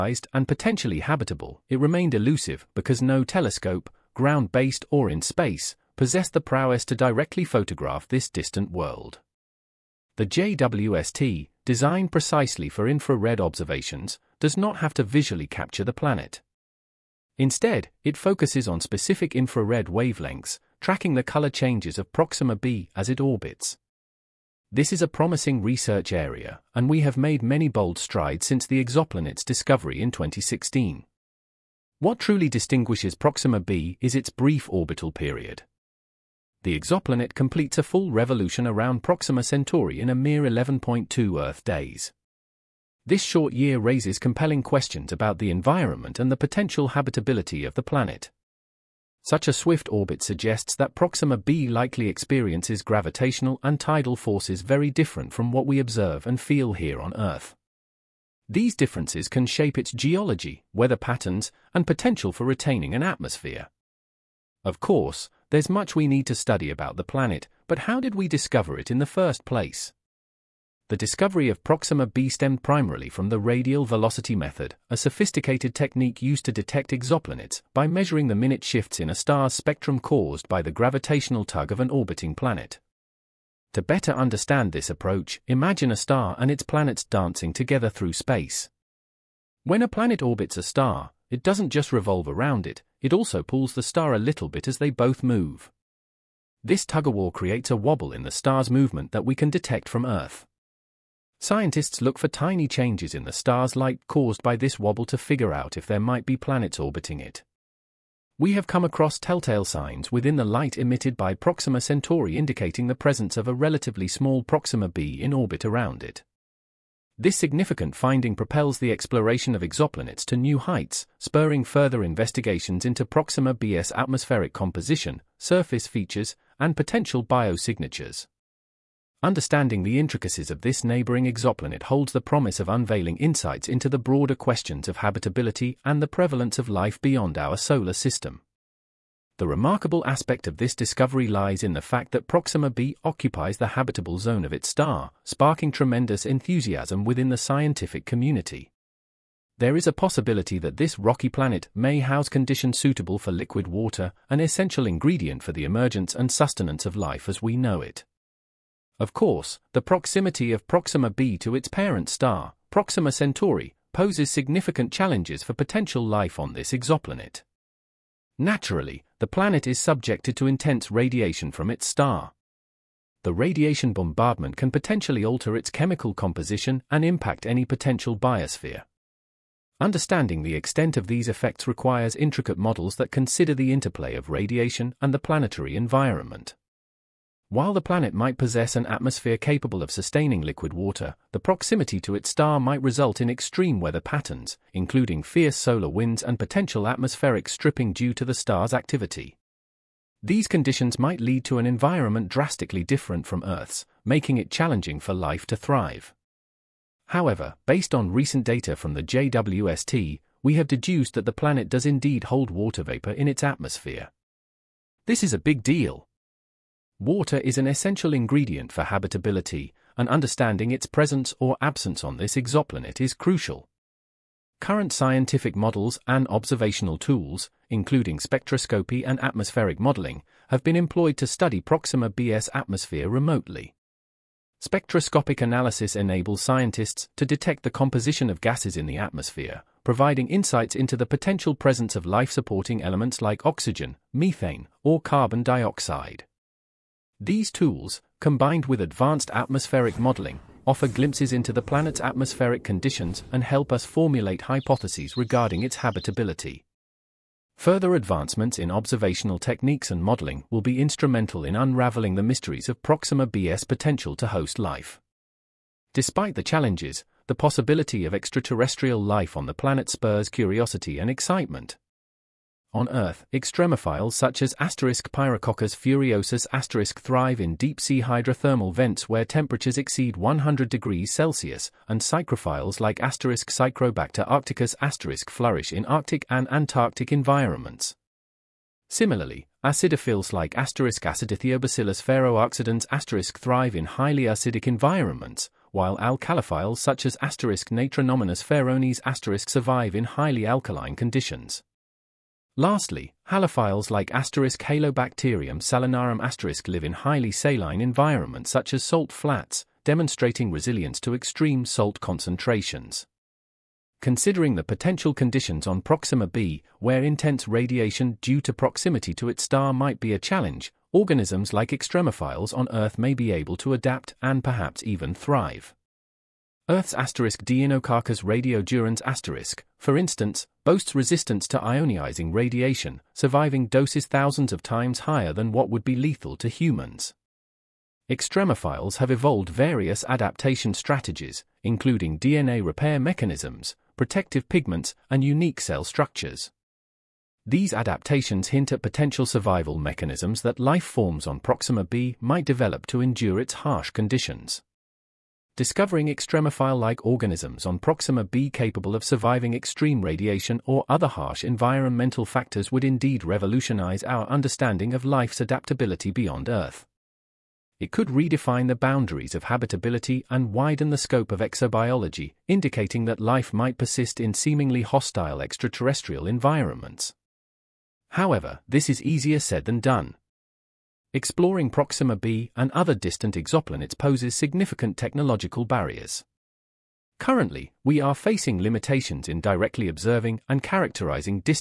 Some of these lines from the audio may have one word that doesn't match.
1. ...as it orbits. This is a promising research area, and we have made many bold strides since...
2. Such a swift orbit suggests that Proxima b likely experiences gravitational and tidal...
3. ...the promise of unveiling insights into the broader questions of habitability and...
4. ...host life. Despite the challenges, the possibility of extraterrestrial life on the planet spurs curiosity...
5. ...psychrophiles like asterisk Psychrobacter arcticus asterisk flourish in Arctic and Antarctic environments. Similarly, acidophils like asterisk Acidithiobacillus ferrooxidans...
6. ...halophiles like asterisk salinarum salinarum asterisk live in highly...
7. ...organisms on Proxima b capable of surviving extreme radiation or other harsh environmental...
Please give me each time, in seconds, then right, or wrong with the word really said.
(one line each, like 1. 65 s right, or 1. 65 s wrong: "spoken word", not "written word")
1. 22 s right
2. 49 s right
3. 132 s right
4. 264 s right
5. 282 s right
6. 303 s wrong: "halobacterium", not "salinarum"
7. 357 s right.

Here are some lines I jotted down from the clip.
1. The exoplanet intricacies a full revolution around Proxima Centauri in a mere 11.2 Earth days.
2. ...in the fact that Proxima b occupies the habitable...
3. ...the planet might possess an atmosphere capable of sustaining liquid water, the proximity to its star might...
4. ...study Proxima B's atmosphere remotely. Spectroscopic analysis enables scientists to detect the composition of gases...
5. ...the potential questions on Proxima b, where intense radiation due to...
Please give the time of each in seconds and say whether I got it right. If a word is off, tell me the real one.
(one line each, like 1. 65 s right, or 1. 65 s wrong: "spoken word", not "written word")
1. 36 s wrong: "completes", not "intricacies"
2. 141 s right
3. 187 s right
4. 231 s right
5. 314 s wrong: "conditions", not "questions".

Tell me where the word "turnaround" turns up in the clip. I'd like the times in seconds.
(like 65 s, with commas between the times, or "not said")
not said.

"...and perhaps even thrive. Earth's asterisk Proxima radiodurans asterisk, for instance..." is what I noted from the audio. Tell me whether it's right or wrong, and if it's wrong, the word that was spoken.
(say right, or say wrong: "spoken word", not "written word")
wrong: "Deinococcus", not "Proxima".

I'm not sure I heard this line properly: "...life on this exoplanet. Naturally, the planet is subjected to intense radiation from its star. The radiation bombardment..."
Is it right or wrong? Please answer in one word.
right.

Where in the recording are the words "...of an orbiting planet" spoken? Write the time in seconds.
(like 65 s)
81 s.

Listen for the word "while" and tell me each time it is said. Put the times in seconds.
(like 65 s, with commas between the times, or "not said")
187 s, 295 s.